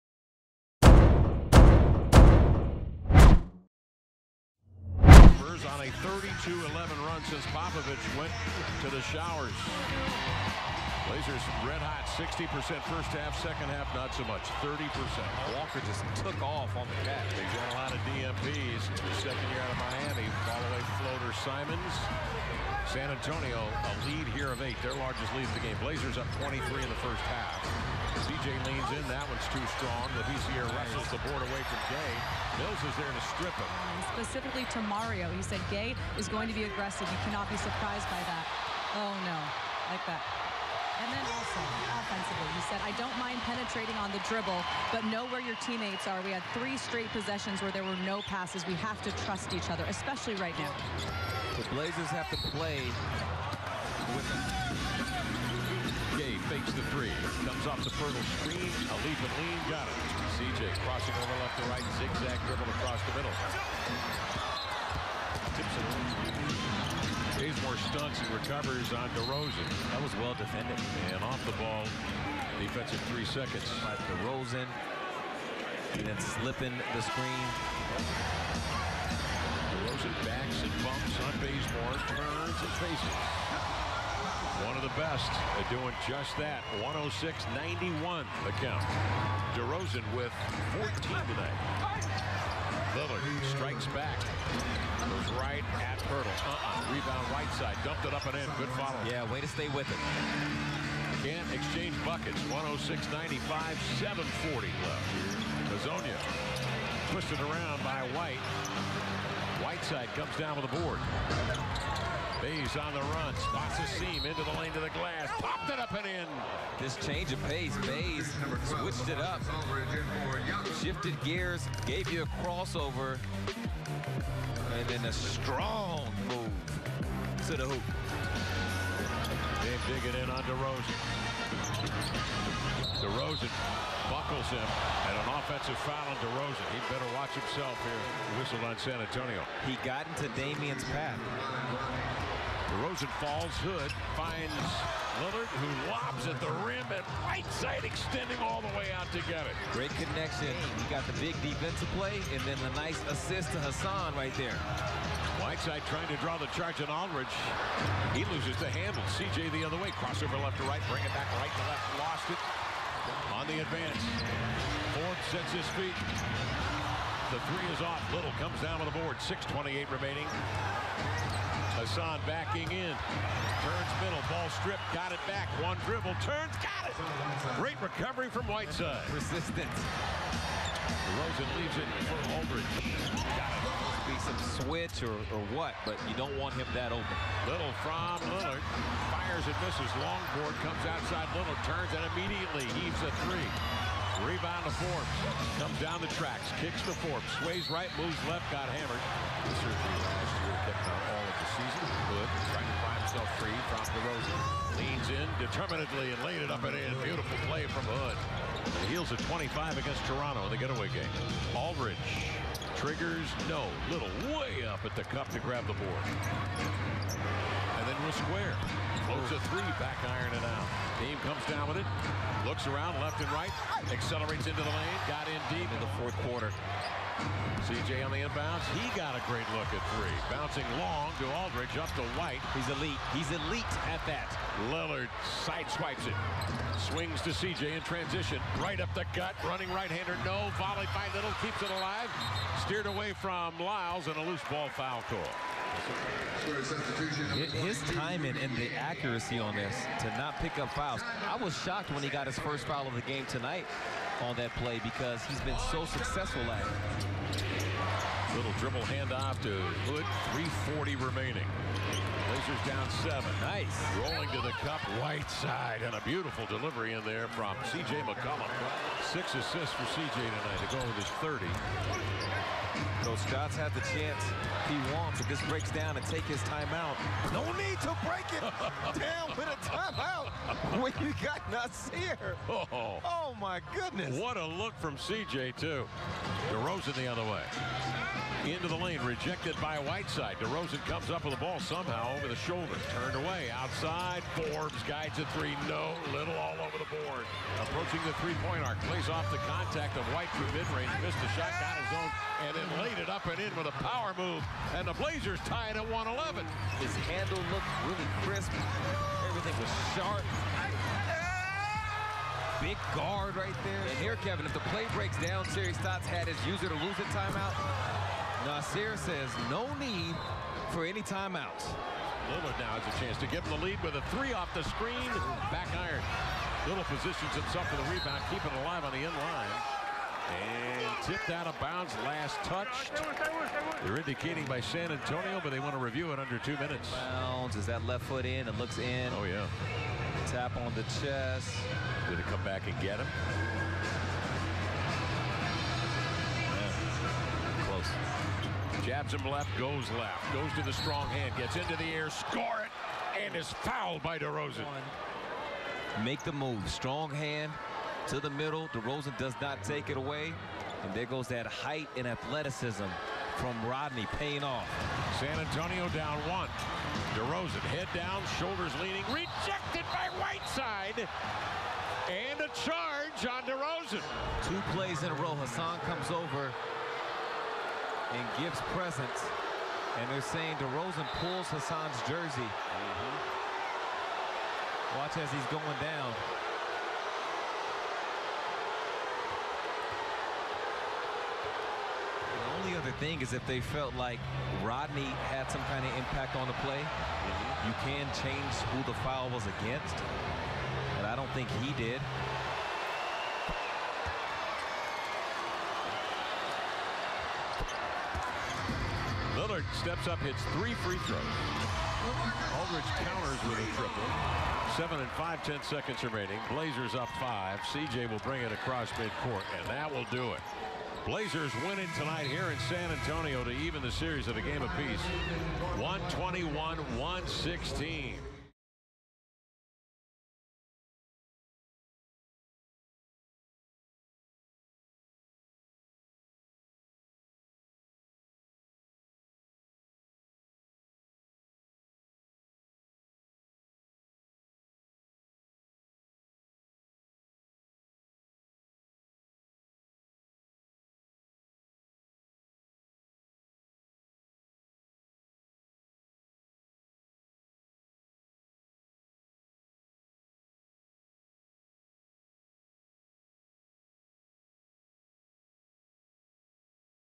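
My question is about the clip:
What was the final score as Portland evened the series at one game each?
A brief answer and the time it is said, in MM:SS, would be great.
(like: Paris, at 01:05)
121-116, at 07:05.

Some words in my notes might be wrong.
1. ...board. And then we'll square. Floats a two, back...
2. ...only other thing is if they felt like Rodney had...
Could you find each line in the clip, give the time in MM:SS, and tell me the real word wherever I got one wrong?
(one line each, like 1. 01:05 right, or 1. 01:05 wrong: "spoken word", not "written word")
1. 03:35 wrong: "three", not "two"
2. 06:32 right.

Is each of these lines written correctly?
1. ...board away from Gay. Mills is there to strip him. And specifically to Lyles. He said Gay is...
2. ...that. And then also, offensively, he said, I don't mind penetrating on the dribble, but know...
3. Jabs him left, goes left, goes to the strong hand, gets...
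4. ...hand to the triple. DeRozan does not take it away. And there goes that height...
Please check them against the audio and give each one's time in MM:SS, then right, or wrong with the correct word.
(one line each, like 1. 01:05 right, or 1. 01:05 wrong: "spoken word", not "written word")
1. 00:31 wrong: "Mario", not "Lyles"
2. 00:40 right
3. 05:48 right
4. 05:57 wrong: "middle", not "triple".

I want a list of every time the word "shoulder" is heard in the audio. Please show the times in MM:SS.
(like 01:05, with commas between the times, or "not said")
04:52, 06:08.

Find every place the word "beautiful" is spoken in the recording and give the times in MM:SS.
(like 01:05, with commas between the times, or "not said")
03:27, 04:26.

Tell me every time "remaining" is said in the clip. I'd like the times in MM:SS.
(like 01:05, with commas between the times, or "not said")
02:49, 04:20, 06:56.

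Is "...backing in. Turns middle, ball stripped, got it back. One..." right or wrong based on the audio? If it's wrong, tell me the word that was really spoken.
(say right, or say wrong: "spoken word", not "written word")
right.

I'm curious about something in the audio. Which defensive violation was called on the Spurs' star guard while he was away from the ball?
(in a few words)
Defensive three seconds.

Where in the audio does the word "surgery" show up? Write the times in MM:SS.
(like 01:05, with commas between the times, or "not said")
03:19.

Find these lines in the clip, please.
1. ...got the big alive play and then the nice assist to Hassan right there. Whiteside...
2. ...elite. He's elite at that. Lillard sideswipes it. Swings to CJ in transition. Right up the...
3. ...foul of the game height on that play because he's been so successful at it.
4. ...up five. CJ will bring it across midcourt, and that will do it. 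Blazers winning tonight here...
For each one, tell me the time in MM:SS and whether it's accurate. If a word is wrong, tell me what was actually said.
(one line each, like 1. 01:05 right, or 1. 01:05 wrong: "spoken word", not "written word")
1. 02:30 wrong: "defensive", not "alive"
2. 03:52 right
3. 04:12 wrong: "tonight", not "height"
4. 06:56 right.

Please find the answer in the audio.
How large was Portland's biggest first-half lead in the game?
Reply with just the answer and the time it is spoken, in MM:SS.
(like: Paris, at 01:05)
23, at 00:25.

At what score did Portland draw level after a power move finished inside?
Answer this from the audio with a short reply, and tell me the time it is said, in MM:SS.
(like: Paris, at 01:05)
111, at 05:05.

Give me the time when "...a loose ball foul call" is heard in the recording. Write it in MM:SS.
04:04.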